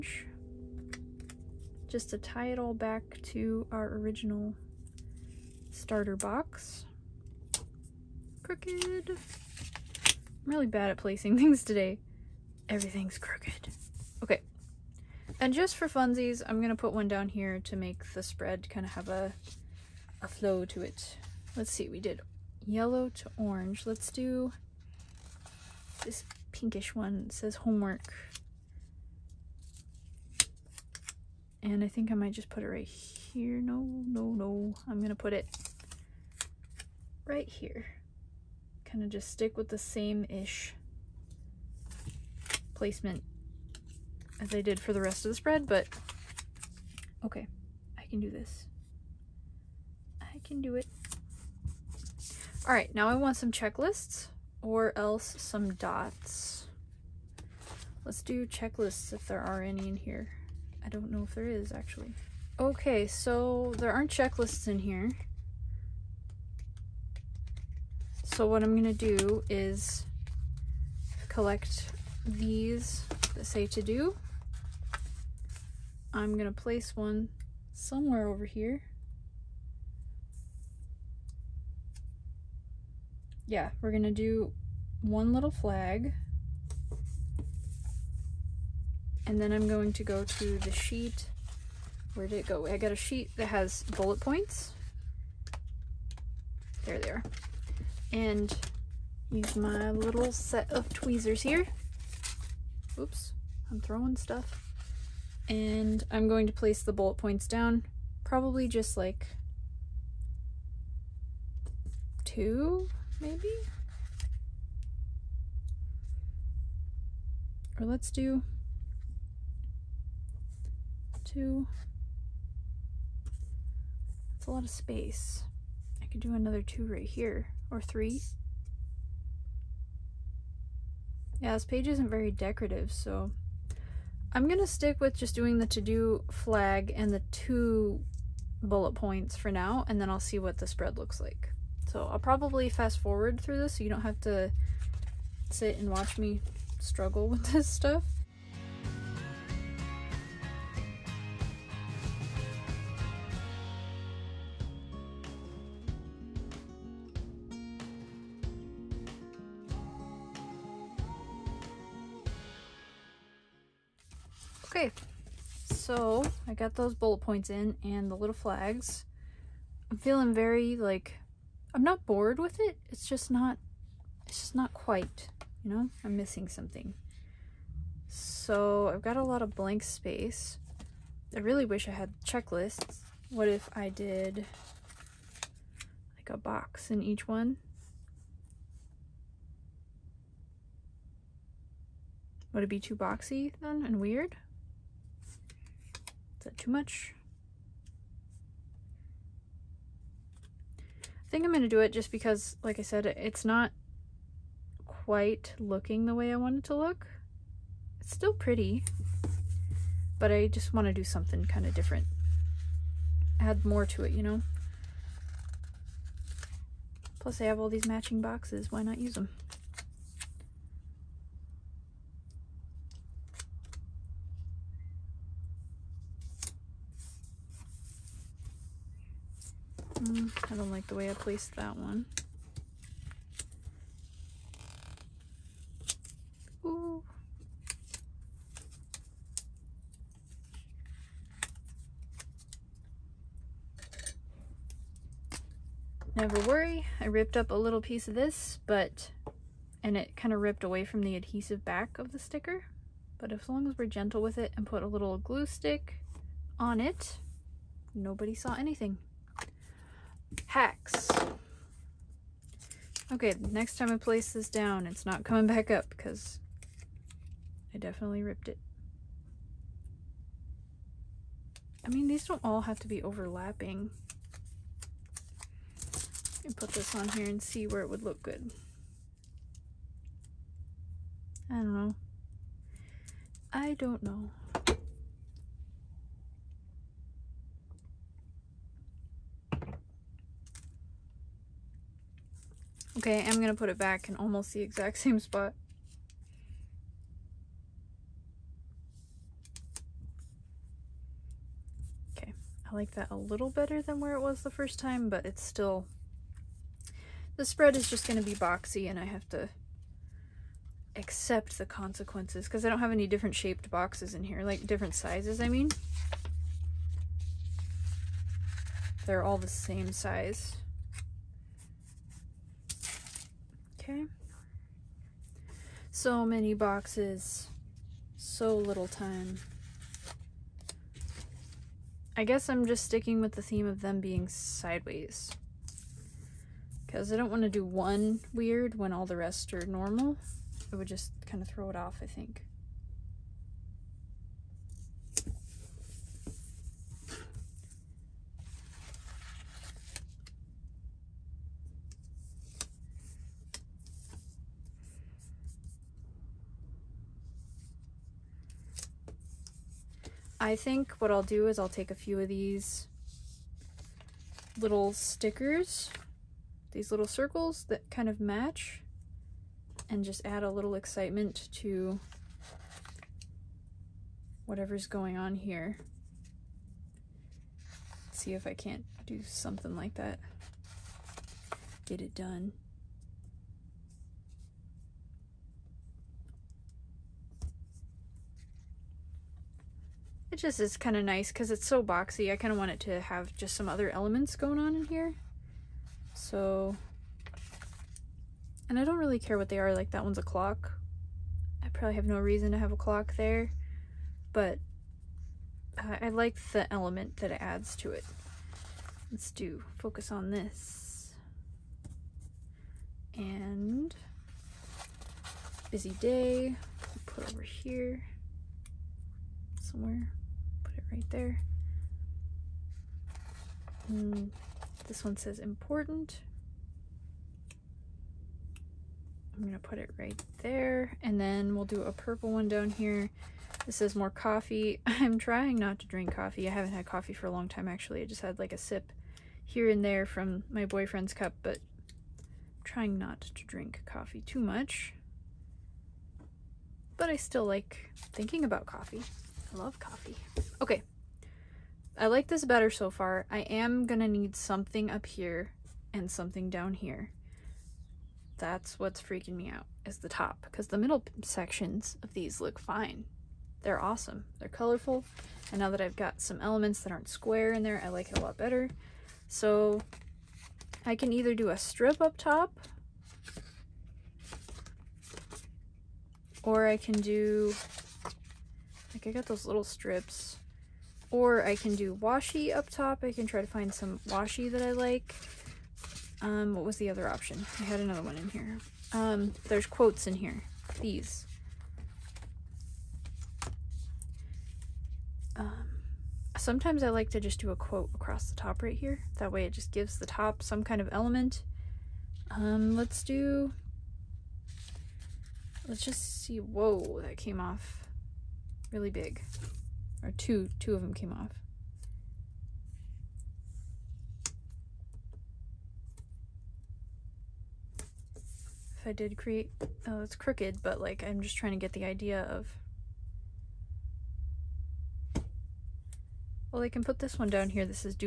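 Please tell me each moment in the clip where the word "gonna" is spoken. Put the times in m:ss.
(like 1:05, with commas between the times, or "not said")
1:08, 1:16, 1:23, 2:14, 4:53, 5:08, 7:09, 7:33.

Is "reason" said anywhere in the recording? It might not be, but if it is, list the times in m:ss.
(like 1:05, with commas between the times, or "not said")
6:42.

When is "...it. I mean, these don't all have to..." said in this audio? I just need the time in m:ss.
4:28.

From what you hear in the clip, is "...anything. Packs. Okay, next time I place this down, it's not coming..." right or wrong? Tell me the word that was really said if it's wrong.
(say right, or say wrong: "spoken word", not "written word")
right.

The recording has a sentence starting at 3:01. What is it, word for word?
I really wish I had checklists.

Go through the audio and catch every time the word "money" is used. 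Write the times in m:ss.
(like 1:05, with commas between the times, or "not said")
not said.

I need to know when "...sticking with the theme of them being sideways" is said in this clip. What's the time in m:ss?
5:32.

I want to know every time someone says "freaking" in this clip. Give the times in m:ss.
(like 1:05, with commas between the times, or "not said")
7:39.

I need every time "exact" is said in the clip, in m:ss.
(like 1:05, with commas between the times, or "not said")
4:54.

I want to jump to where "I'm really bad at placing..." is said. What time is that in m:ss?
0:09.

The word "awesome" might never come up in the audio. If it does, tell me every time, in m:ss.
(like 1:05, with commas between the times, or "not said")
7:43.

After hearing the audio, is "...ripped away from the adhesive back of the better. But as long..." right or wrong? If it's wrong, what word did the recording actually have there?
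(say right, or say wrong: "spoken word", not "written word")
wrong: "sticker", not "better".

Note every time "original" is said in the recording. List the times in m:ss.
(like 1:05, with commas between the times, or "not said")
0:03.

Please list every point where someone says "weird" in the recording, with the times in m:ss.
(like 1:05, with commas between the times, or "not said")
3:13, 5:38.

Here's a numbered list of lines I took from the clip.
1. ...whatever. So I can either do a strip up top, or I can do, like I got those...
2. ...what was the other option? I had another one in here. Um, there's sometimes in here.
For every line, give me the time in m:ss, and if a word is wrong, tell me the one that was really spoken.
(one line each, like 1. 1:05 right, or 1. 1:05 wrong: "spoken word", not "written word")
1. 7:48 wrong: "better", not "whatever"
2. 8:06 wrong: "quotes", not "sometimes".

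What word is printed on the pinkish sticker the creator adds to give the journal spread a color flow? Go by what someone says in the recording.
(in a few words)
Homework.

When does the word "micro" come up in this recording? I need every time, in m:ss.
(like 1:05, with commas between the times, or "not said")
not said.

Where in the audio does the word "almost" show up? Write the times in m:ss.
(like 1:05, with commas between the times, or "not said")
4:54.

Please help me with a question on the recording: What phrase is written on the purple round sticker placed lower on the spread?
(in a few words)
More coffee.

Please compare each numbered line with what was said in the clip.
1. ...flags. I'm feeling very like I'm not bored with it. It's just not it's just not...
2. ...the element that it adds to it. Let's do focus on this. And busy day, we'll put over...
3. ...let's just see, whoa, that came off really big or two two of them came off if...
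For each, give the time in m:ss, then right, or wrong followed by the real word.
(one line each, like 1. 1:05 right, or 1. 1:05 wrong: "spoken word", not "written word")
1. 2:48 right
2. 6:46 right
3. 8:25 right.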